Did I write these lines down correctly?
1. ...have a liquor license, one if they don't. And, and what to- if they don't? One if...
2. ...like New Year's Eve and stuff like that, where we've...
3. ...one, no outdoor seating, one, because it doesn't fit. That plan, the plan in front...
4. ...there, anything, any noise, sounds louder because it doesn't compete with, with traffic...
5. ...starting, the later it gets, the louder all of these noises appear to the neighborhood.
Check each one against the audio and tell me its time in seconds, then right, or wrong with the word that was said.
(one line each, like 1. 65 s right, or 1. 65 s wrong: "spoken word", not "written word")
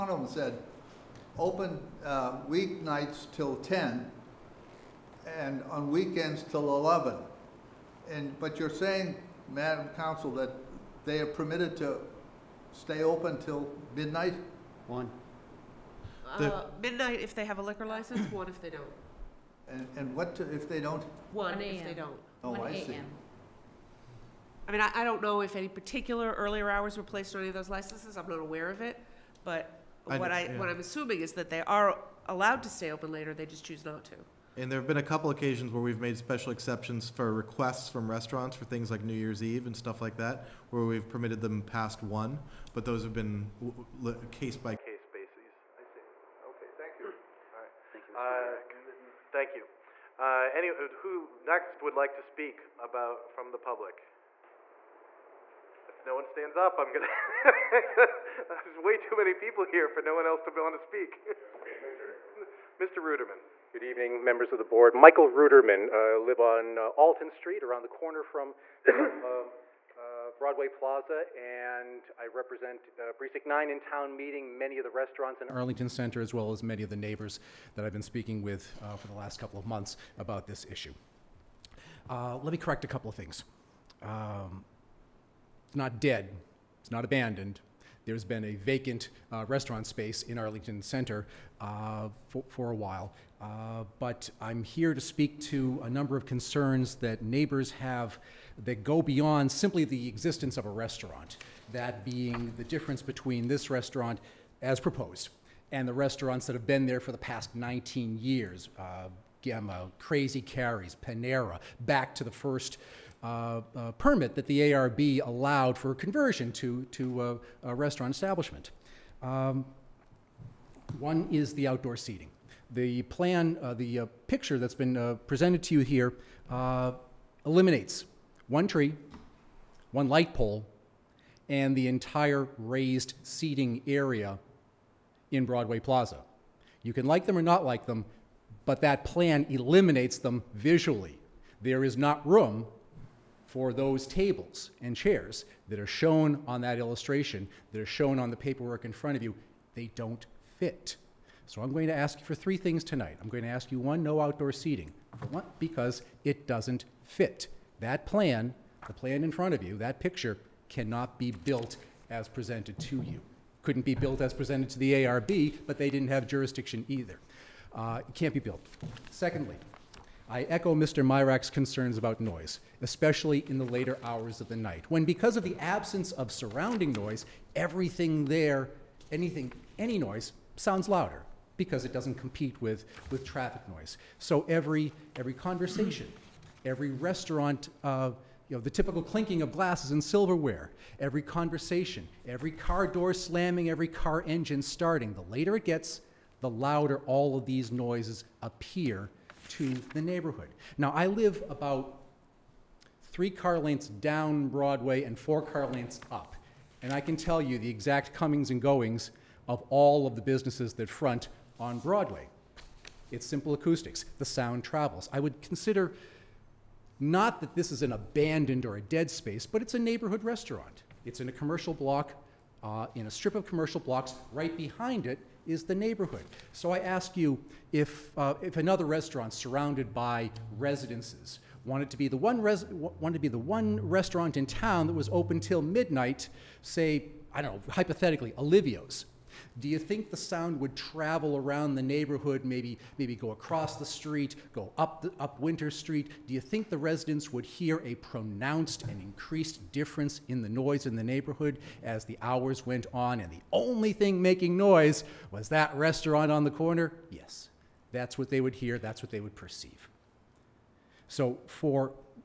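1. 17 s right
2. 38 s right
3. 153 s right
4. 178 s right
5. 194 s right.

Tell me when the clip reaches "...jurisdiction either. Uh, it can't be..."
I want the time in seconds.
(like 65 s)
166 s.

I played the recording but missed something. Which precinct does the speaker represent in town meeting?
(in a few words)
Precinct 9.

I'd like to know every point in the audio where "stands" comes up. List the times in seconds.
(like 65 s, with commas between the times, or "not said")
56 s.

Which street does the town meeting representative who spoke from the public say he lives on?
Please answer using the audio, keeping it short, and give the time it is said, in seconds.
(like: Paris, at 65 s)
Alton Street, at 66 s.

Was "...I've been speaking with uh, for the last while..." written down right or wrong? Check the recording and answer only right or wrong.
wrong.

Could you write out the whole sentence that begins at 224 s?
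Right behind it is the neighborhood.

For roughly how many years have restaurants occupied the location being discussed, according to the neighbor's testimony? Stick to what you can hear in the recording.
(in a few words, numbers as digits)
19 years.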